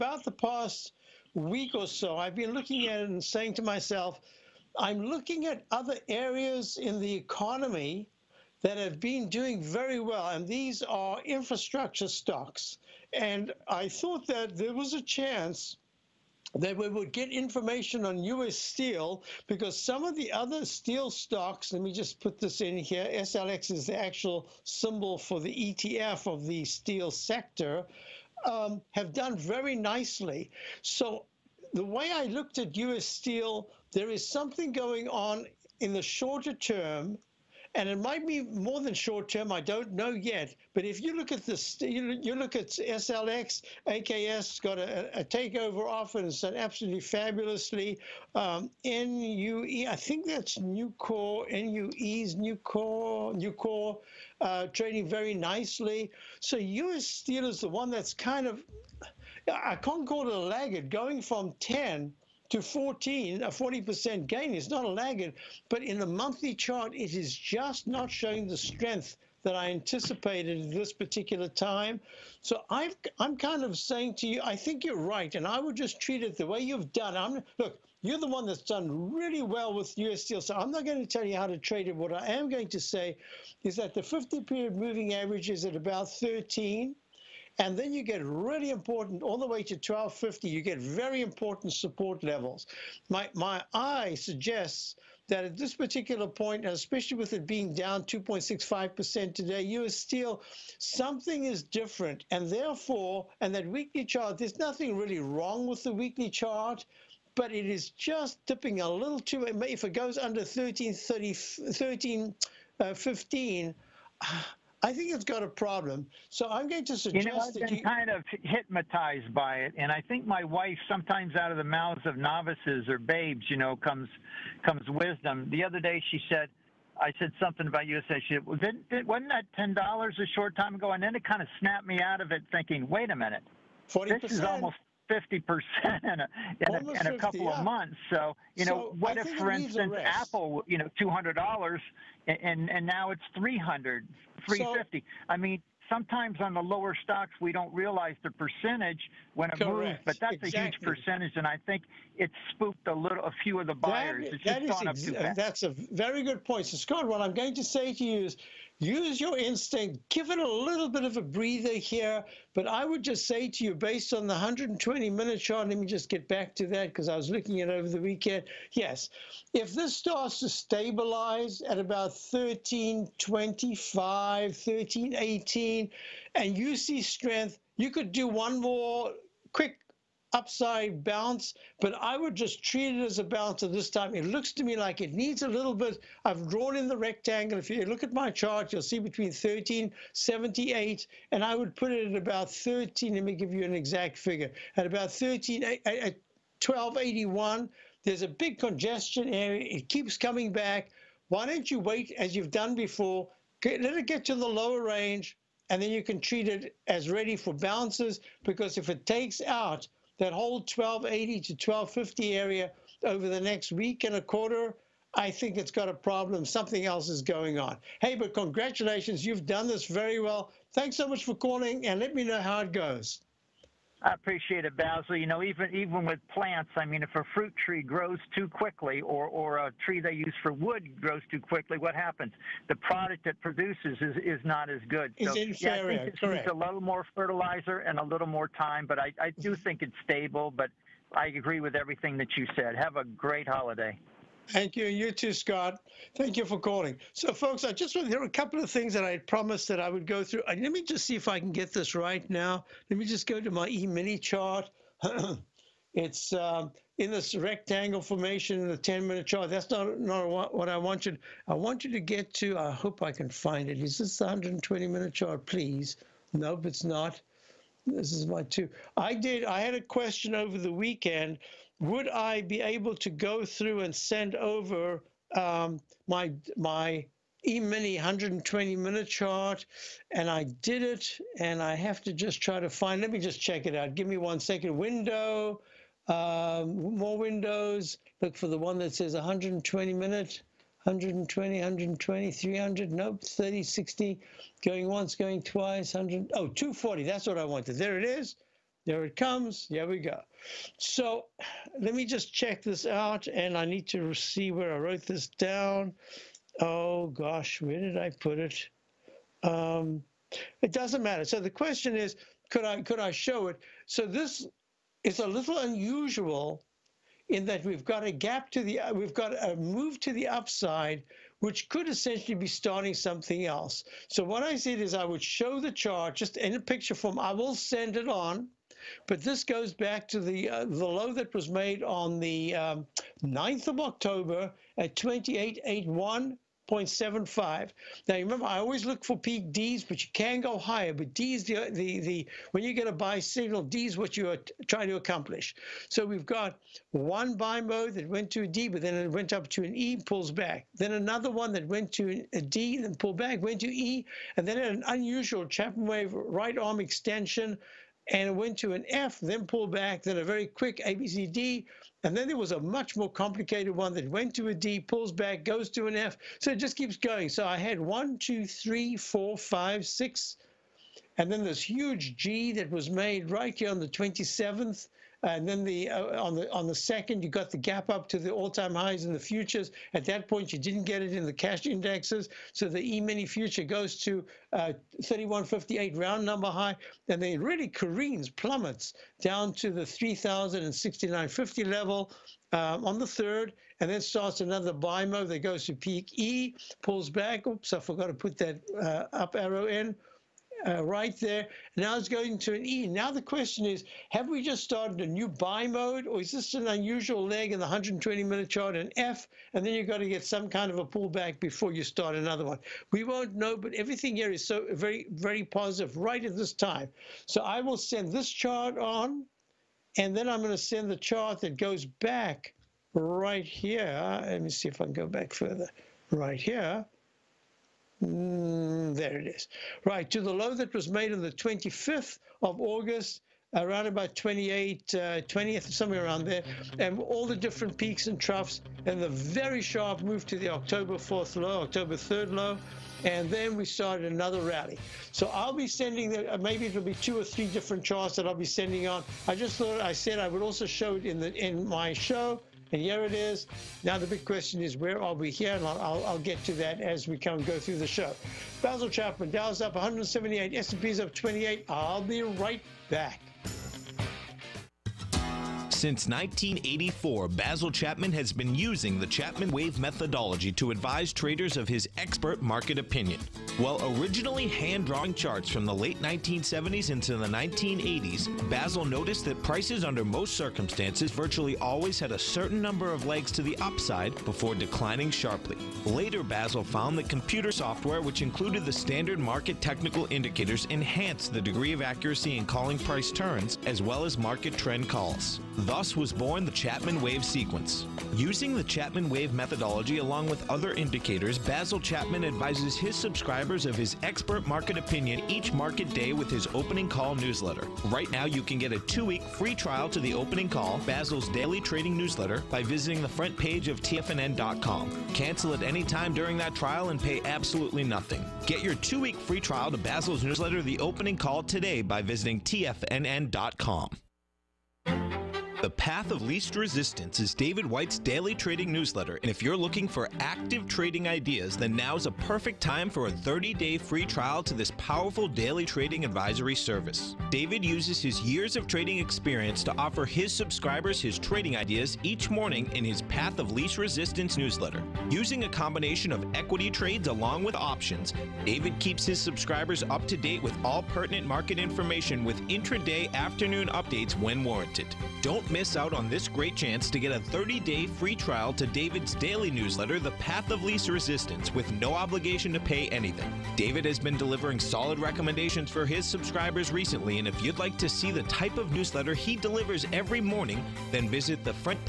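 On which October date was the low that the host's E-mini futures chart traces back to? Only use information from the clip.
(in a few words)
9th of October.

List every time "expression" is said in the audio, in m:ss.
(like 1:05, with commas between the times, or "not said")
not said.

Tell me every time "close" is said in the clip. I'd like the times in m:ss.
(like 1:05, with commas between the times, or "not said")
not said.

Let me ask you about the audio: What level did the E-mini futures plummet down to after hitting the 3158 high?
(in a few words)
3069.50.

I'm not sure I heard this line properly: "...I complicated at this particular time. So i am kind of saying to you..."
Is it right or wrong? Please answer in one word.
wrong.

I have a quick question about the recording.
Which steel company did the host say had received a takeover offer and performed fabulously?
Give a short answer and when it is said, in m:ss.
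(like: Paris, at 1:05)
AKS, at 0:43.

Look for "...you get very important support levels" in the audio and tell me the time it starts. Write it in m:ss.
1:30.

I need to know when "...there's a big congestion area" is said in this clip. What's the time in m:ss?
3:18.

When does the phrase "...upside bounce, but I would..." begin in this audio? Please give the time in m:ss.
3:00.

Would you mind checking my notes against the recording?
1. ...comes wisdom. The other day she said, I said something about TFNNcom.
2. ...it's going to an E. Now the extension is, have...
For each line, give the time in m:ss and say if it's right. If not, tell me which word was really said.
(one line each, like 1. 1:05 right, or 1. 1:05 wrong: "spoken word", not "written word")
1. 2:04 wrong: "USA", not "TFNNcom"
2. 6:41 wrong: "question", not "extension".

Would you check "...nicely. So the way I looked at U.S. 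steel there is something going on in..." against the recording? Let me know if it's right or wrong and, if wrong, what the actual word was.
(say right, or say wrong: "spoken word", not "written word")
right.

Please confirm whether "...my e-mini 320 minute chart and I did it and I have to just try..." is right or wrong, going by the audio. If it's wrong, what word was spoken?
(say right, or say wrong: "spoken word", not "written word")
wrong: "120", not "320".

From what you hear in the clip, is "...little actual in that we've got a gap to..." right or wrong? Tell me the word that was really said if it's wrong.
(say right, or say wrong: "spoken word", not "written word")
wrong: "unusual", not "actual".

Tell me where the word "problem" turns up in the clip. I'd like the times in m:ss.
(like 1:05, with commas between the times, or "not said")
1:55, 3:35.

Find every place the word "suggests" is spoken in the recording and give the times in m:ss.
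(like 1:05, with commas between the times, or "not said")
1:34, 1:56.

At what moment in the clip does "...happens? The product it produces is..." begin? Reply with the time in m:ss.
3:51.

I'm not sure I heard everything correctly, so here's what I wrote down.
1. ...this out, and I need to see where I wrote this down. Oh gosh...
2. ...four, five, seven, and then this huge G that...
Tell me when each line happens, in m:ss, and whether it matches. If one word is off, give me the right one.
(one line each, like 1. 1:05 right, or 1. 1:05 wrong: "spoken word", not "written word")
1. 5:02 right
2. 6:08 wrong: "six", not "seven".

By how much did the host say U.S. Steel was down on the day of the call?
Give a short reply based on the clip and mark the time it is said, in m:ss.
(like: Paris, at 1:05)
2.65%, at 1:37.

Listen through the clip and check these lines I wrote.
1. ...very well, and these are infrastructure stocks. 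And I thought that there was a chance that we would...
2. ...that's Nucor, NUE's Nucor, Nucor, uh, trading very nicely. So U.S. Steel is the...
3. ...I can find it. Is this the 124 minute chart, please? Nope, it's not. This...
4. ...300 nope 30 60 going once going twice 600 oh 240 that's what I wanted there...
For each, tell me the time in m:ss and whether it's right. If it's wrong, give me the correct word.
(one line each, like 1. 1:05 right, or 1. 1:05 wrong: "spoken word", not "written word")
1. 0:09 right
2. 0:50 right
3. 4:23 wrong: "120", not "124"
4. 4:52 wrong: "100", not "600".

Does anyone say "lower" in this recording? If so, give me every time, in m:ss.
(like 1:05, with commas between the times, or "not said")
2:26, 3:24.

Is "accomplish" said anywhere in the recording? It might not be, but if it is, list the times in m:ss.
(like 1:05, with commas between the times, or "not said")
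5:44.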